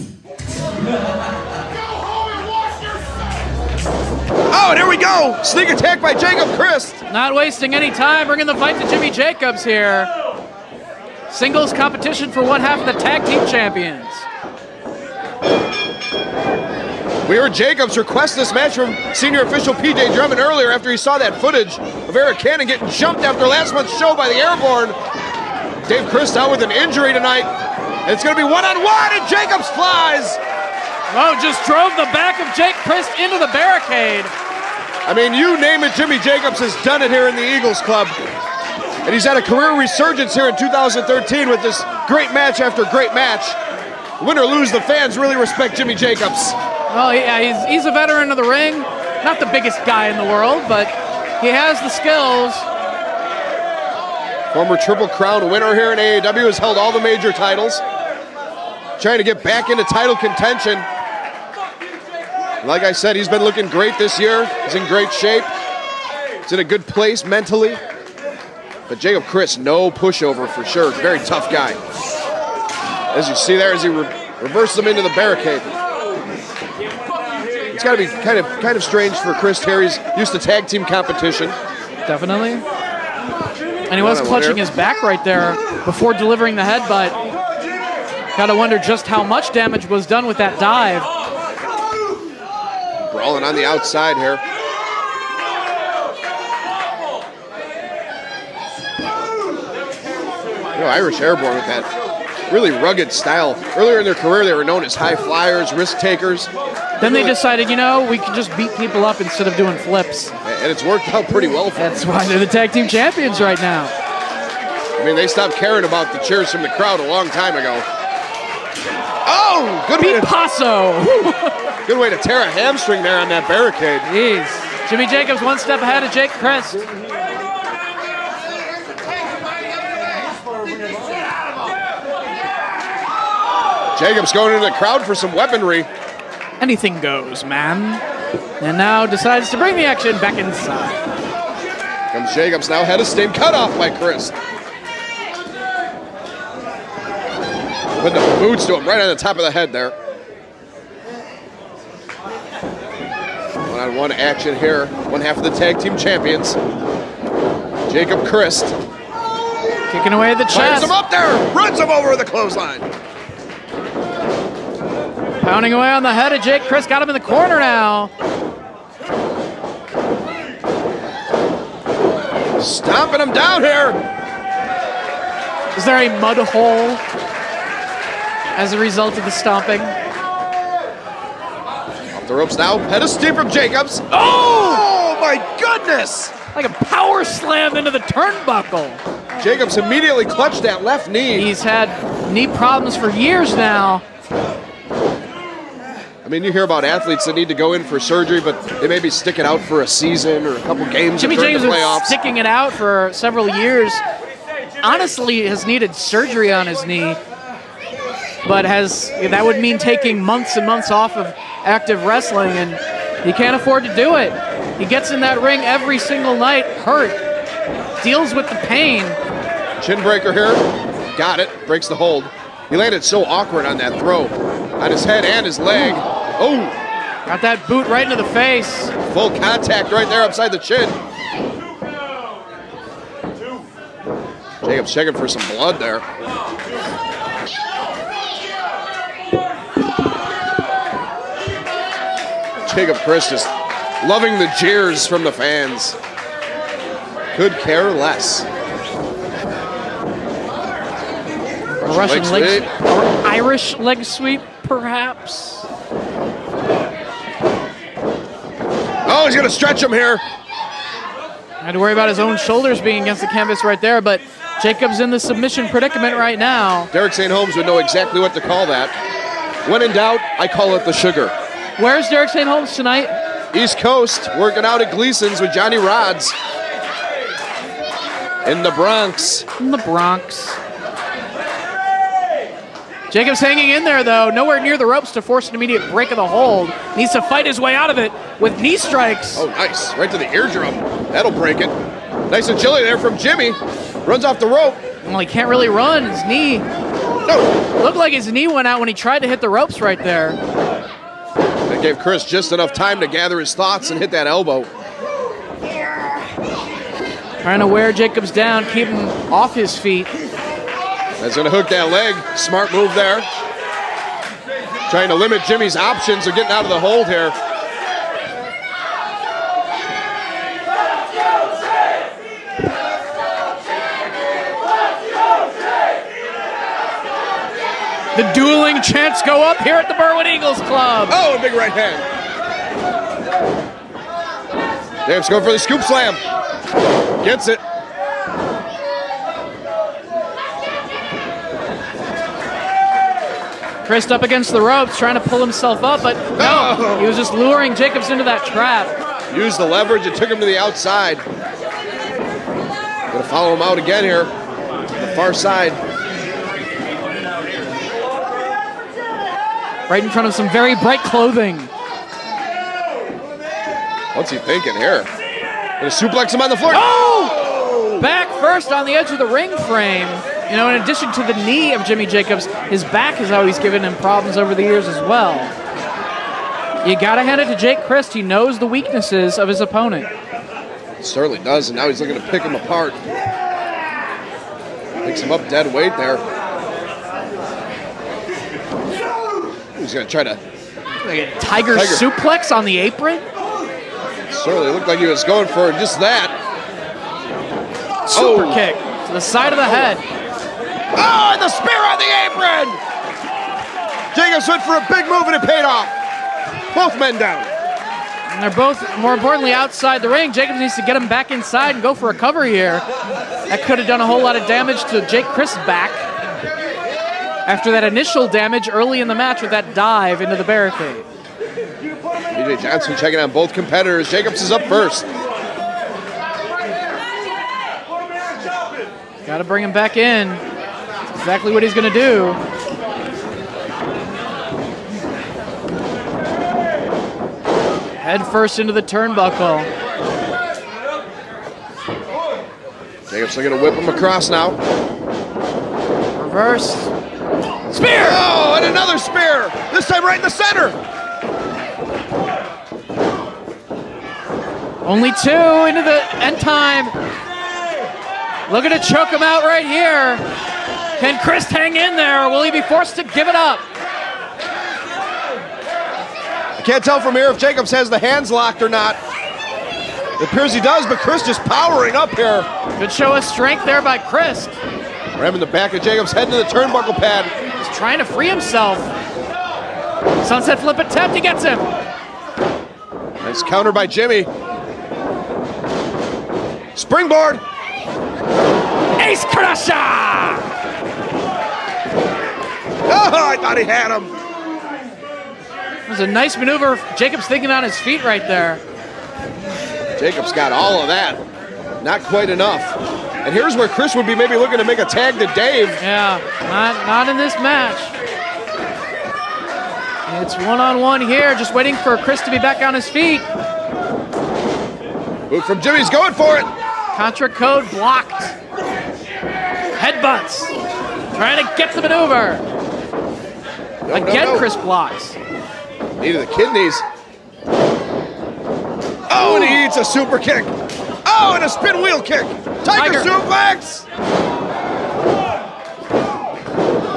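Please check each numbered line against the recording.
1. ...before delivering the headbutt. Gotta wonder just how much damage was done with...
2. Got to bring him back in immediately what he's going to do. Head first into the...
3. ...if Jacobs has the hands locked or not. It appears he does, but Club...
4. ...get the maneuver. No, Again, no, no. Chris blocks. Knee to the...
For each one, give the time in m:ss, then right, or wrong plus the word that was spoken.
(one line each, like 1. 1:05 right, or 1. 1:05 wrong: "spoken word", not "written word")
1. 1:25 right
2. 7:09 wrong: "exactly", not "immediately"
3. 7:47 wrong: "Chris", not "Club"
4. 8:41 right.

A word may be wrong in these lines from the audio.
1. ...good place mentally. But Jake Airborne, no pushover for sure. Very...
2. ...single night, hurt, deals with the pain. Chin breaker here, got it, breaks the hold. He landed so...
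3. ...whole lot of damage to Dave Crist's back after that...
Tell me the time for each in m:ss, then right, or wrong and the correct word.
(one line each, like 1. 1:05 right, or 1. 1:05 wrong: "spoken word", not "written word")
1. 1:06 wrong: "Crist", not "Airborne"
2. 3:35 right
3. 6:54 wrong: "Jake", not "Dave".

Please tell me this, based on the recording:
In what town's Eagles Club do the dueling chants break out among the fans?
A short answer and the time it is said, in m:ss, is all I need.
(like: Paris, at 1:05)
Berwyn, at 5:29.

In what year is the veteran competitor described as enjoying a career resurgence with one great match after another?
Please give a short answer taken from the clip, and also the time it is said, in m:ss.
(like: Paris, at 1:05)
2013, at 0:40.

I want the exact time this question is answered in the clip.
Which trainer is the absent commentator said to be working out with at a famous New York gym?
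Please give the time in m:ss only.
4:35.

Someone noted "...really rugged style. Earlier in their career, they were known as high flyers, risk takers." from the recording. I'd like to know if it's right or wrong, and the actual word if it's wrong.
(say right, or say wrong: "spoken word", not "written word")
right.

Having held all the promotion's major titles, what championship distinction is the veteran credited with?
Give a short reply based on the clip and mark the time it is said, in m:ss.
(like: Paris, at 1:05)
Triple Crown winner, at 0:54.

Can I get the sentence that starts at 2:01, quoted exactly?
good way to tear a hamstring there on that barricade.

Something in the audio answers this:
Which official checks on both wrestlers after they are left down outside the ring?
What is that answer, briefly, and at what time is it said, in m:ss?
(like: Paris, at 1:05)
DJ Johnson, at 7:01.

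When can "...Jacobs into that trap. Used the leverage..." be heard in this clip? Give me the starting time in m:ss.
5:47.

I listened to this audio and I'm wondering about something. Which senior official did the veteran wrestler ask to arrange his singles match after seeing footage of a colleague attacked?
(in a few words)
P.J. Drummond.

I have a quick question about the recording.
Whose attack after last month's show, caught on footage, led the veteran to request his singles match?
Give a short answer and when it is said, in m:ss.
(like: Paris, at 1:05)
Eric Cannon, at 0:22.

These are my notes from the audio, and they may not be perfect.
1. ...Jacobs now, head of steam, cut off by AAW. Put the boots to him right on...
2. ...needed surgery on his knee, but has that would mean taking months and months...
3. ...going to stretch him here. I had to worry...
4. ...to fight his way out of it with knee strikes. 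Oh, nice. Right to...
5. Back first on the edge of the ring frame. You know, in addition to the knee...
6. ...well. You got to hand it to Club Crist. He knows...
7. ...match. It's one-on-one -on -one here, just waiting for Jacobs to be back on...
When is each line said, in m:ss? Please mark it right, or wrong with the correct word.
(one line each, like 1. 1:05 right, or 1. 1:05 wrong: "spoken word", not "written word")
1. 2:22 wrong: "Chris", not "AAW"
2. 3:25 right
3. 4:19 right
4. 4:47 right
5. 6:08 right
6. 6:15 wrong: "Jake", not "Club"
7. 8:27 wrong: "Chris", not "Jacobs".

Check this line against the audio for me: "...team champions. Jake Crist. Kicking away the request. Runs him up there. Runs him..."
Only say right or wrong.
wrong.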